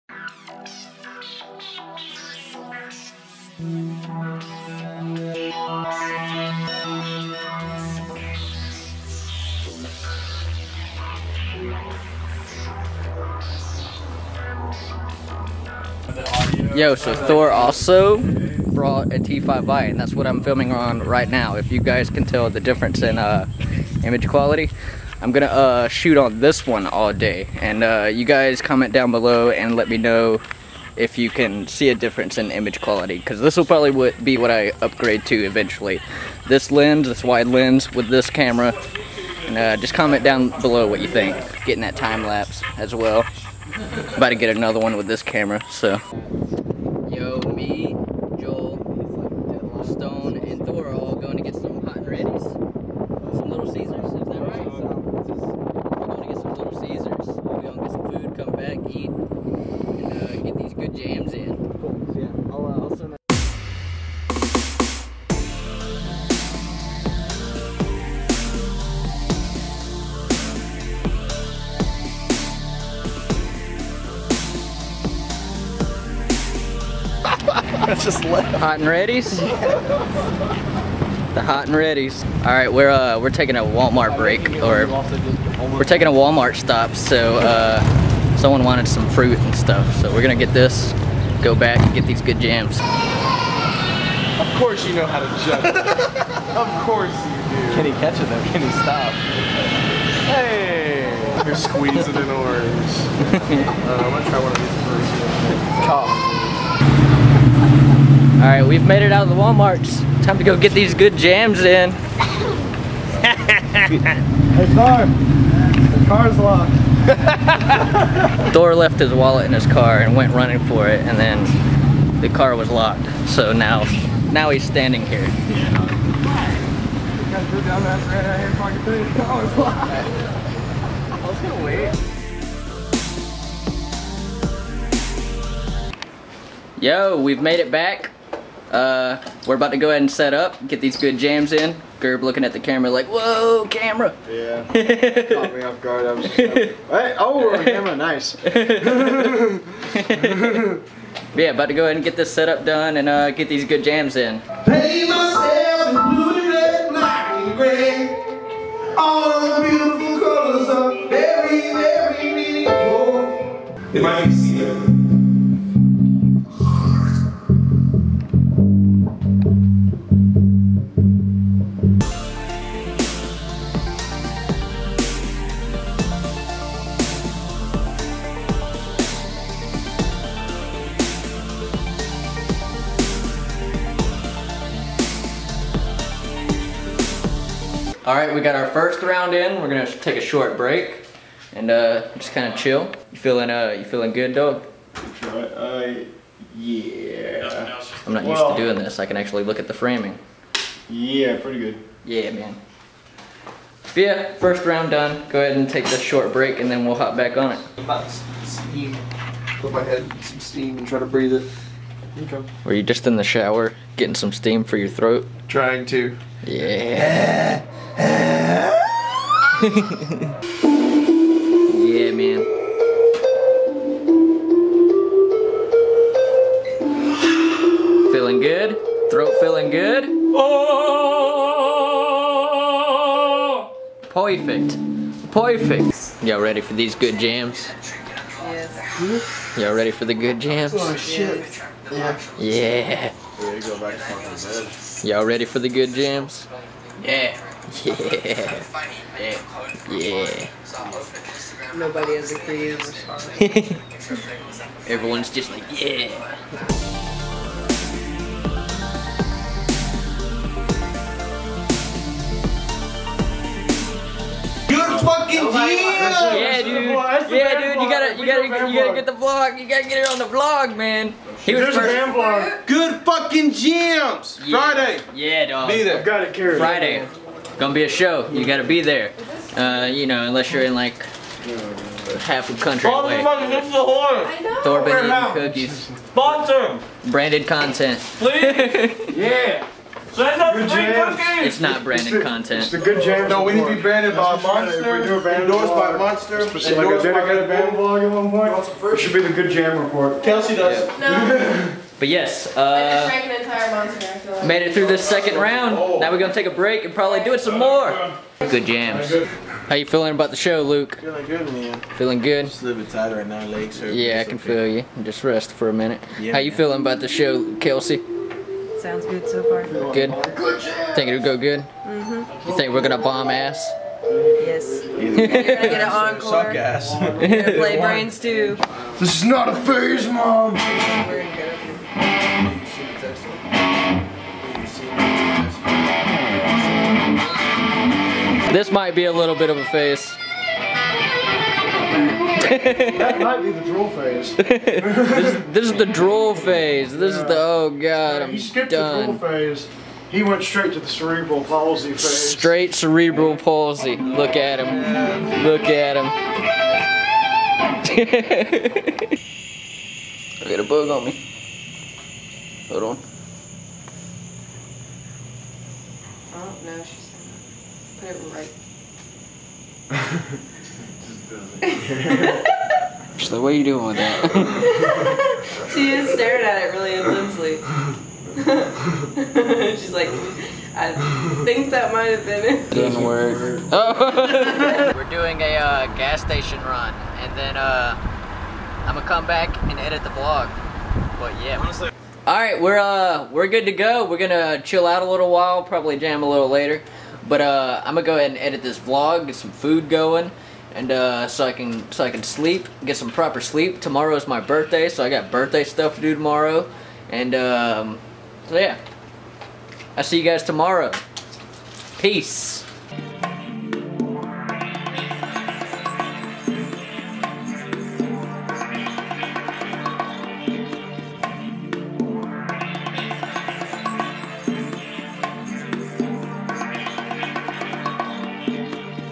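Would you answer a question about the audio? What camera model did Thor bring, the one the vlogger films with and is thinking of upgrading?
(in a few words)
T5i.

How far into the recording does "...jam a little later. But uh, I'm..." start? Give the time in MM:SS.
06:35.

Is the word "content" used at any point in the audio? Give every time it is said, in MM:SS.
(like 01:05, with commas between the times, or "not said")
04:47, 04:52.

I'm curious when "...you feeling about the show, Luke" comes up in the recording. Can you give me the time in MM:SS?
05:09.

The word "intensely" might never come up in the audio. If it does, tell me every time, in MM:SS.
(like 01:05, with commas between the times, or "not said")
06:16.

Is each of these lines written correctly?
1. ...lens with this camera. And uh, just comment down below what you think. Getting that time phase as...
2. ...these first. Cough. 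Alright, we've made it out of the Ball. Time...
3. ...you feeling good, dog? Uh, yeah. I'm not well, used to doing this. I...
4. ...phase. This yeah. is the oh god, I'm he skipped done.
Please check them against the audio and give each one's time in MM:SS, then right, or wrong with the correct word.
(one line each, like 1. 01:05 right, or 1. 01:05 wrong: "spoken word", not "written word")
1. 00:37 wrong: "lapse", not "phase"
2. 01:44 wrong: "Walmarts", not "Ball"
3. 03:13 right
4. 05:46 right.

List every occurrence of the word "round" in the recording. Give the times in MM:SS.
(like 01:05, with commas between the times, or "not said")
03:09, 03:24, 05:05.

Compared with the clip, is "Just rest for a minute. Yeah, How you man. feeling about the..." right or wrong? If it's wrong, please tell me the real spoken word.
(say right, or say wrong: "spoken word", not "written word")
right.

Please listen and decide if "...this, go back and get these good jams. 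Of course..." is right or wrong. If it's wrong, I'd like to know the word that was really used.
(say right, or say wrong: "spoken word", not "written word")
right.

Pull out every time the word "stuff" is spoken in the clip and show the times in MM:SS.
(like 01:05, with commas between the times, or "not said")
01:29, 06:45.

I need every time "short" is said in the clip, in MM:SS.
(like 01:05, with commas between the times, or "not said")
03:10, 03:26.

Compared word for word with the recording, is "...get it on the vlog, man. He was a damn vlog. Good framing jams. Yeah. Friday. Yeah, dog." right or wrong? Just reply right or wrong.
wrong.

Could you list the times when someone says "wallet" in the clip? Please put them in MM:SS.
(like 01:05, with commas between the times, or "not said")
01:59.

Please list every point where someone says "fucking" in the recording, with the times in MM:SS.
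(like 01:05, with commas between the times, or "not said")
04:25, 04:33.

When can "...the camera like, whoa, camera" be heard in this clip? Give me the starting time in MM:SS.
02:22.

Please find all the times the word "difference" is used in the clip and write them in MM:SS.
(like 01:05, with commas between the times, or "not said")
00:22, 00:31.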